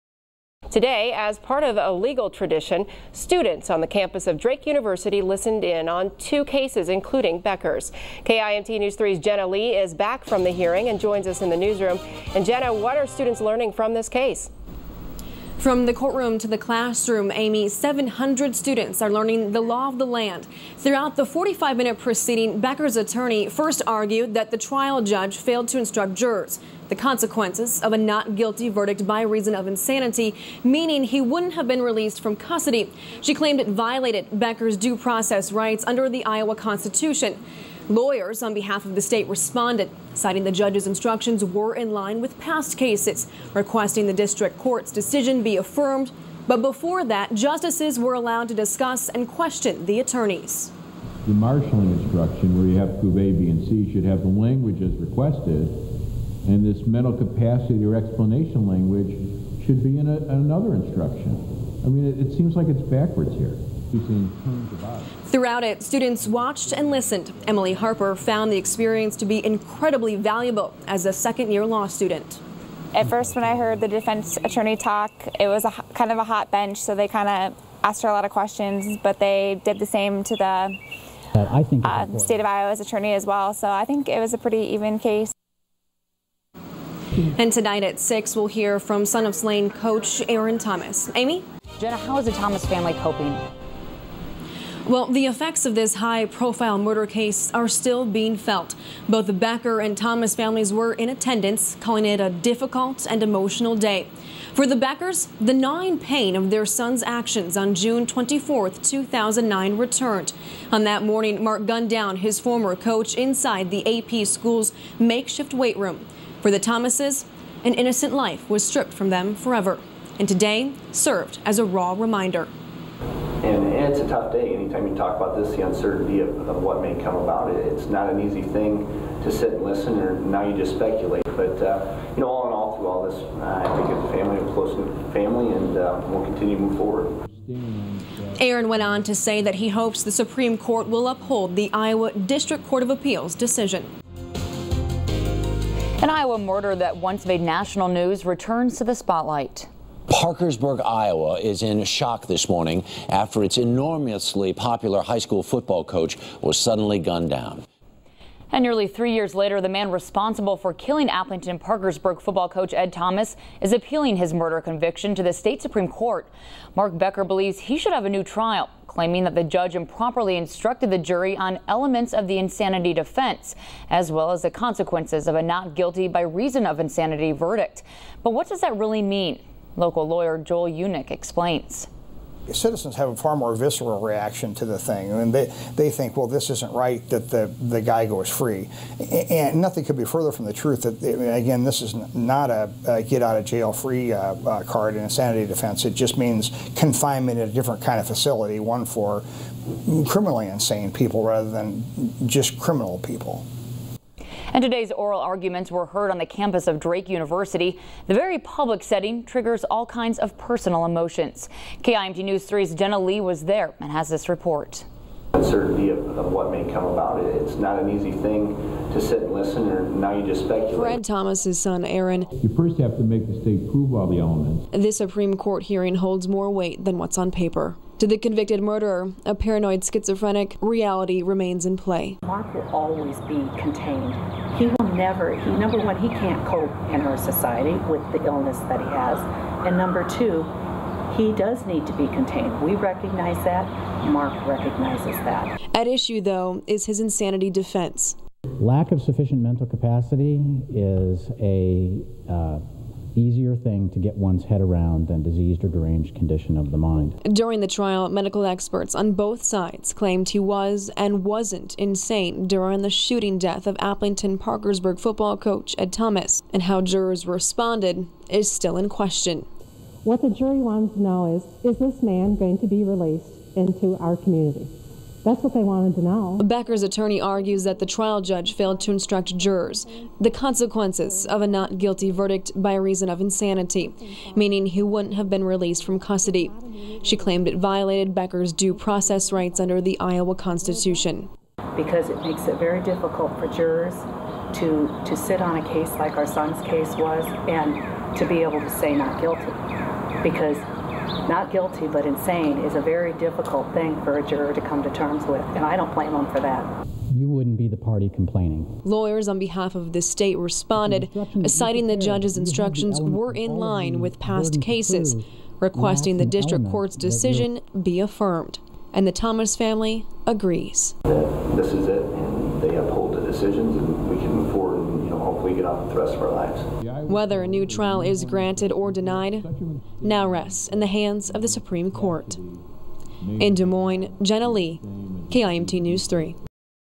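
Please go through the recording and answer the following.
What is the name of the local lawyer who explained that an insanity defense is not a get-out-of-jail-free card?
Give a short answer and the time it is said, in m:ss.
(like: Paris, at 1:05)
Joel Unick, at 3:00.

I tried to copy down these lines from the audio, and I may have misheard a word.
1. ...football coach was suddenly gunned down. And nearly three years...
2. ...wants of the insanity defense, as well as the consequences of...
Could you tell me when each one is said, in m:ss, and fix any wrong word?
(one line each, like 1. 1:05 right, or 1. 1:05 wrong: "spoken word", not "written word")
1. 2:35 right
2. 2:51 wrong: "elements", not "wants".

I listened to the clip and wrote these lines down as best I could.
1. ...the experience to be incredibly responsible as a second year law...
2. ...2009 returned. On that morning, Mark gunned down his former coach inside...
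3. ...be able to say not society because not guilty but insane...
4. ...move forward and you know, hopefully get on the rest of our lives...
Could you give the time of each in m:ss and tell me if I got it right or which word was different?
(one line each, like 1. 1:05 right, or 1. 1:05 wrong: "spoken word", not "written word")
1. 1:08 wrong: "valuable", not "responsible"
2. 1:48 right
3. 4:58 wrong: "guilty", not "society"
4. 5:24 right.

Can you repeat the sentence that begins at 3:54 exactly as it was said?
He will never, he, number one, he can't cope in our society with the illness that he has.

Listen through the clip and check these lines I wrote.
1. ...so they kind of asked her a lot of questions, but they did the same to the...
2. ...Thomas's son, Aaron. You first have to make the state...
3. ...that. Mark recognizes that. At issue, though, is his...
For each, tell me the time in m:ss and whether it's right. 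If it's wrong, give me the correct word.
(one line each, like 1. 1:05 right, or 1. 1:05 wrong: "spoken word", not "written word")
1. 1:16 right
2. 3:41 right
3. 4:03 right.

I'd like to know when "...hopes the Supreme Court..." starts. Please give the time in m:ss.
2:19.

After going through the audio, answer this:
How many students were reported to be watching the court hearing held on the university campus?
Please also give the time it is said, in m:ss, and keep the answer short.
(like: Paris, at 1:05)
700, at 0:17.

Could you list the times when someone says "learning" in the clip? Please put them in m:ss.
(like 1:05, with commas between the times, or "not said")
0:13, 0:19.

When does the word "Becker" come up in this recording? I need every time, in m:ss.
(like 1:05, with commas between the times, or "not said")
0:07, 0:22, 0:34, 1:39, 1:44, 2:46, 4:36, 4:48.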